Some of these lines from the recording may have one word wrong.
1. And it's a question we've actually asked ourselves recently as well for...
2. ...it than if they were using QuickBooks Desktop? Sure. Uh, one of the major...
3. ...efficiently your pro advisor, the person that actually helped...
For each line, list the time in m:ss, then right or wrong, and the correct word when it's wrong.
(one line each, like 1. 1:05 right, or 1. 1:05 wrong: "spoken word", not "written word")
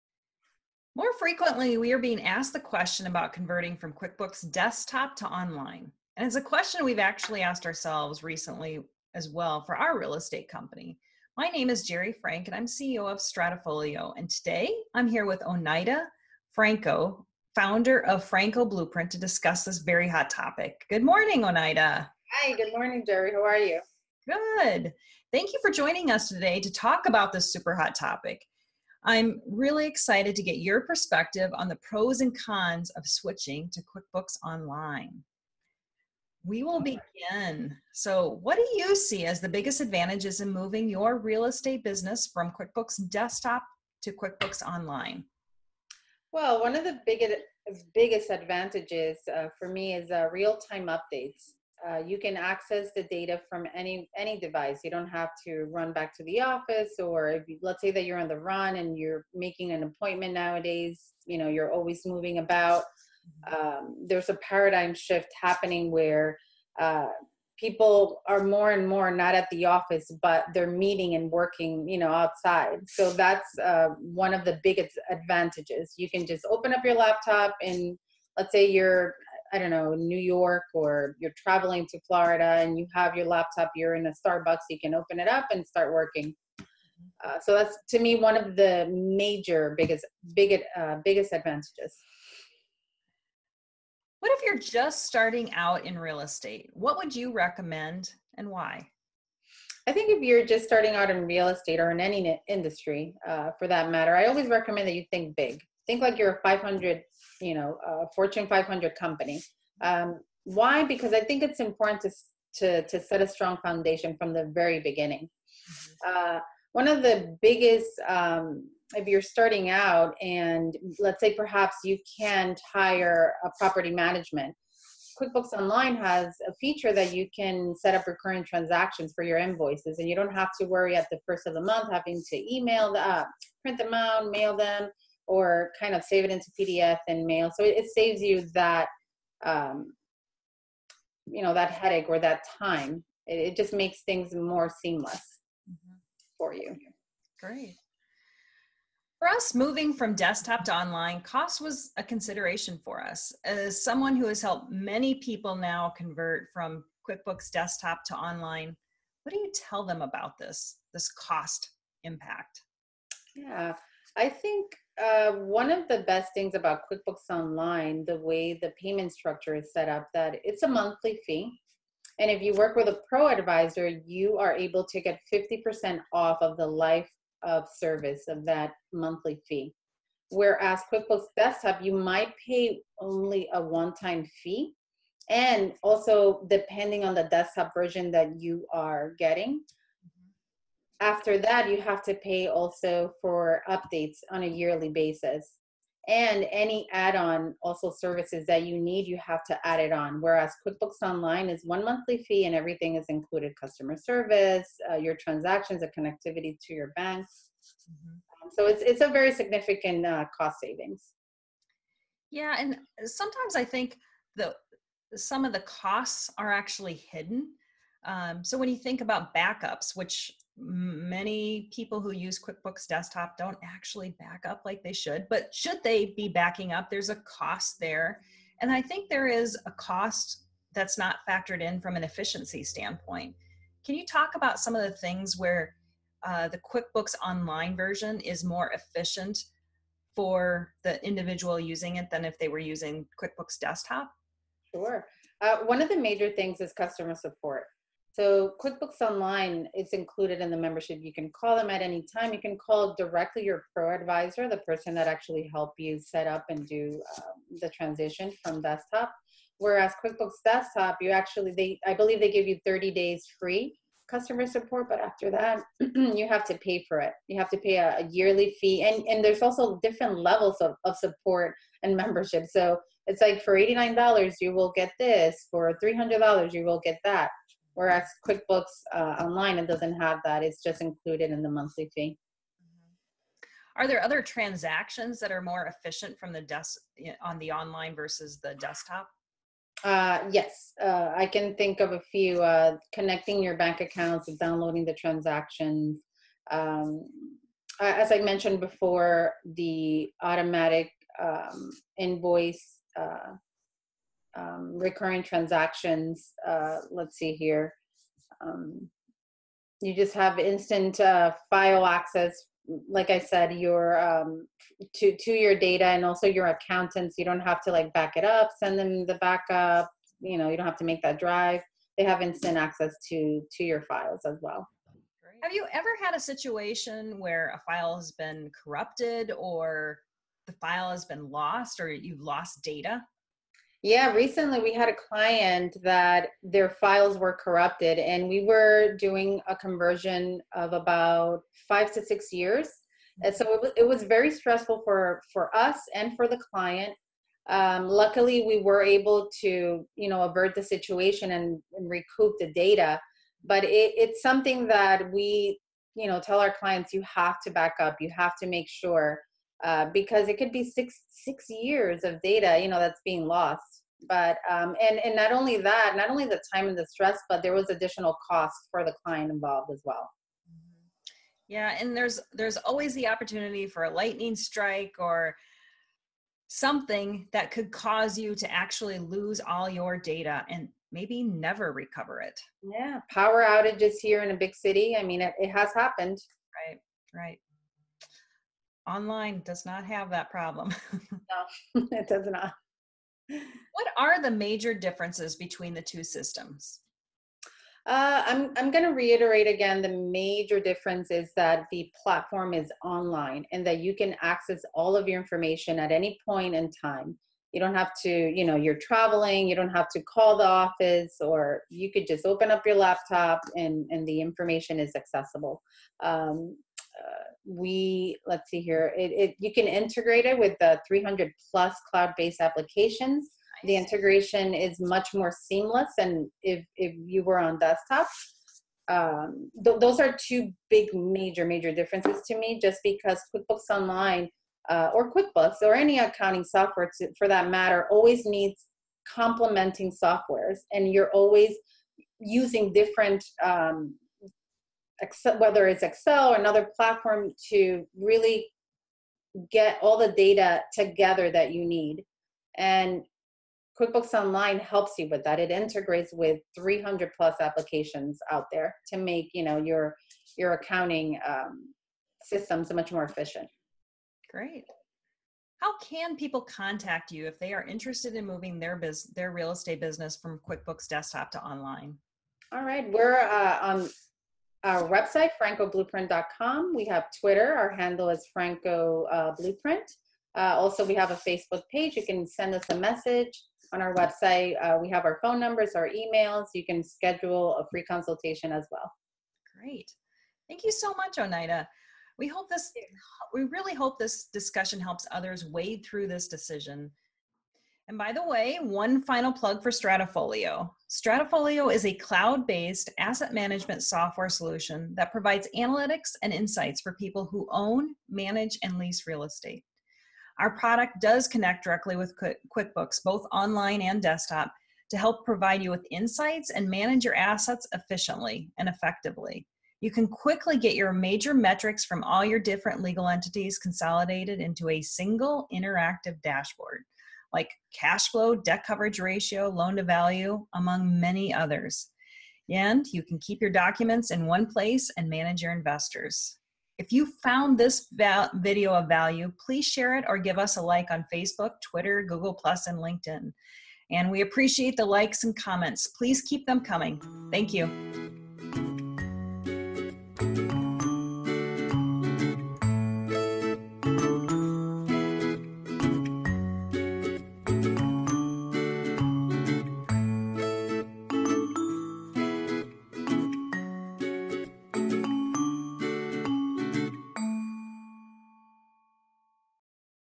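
1. 0:06 right
2. 4:01 right
3. 4:12 wrong: "directly", not "efficiently".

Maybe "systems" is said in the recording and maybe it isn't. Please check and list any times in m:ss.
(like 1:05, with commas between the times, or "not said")
6:36, 7:42.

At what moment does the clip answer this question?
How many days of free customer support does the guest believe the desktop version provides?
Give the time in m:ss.
4:22.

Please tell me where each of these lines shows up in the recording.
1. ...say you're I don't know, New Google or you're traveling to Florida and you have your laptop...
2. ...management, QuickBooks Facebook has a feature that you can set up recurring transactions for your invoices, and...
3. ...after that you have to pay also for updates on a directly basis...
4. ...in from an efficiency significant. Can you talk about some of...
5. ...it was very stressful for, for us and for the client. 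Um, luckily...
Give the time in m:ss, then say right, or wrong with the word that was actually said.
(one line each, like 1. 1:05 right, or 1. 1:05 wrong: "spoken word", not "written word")
1. 1:18 wrong: "York", not "Google"
2. 2:03 wrong: "Online", not "Facebook"
3. 3:11 wrong: "yearly", not "directly"
4. 3:51 wrong: "standpoint", not "significant"
5. 5:43 right.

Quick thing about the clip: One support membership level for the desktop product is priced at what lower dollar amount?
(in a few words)
$89.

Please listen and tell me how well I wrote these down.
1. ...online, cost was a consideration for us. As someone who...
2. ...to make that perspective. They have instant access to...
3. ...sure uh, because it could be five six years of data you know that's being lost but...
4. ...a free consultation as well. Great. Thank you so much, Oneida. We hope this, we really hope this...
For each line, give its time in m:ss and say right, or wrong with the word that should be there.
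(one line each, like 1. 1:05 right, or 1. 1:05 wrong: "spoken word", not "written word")
1. 2:30 right
2. 5:20 wrong: "drive", not "perspective"
3. 5:58 wrong: "six", not "five"
4. 8:07 right.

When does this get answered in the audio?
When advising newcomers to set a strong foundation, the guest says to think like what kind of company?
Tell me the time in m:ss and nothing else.
1:48.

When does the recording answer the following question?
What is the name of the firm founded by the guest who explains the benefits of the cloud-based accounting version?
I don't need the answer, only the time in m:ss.
0:18.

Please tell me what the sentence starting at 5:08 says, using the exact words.
Um, you just have instant uh, file access.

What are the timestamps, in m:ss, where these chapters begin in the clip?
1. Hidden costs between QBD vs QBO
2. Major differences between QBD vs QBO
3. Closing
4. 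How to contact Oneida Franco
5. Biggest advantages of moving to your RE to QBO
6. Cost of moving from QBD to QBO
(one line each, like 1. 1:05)
1. 3:31
2. 6:33
3. 8:11
4. 7:44
5. 0:38
6. 2:27.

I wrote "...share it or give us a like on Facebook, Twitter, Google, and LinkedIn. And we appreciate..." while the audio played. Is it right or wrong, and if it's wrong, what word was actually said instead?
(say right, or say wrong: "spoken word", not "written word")
right.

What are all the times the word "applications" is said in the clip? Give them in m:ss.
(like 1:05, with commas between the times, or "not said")
7:02, 7:37.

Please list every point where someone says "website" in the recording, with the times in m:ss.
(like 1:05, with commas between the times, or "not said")
7:54, 8:03.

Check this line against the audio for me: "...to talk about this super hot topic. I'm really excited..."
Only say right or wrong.
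right.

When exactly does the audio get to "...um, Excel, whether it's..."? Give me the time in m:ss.
7:23.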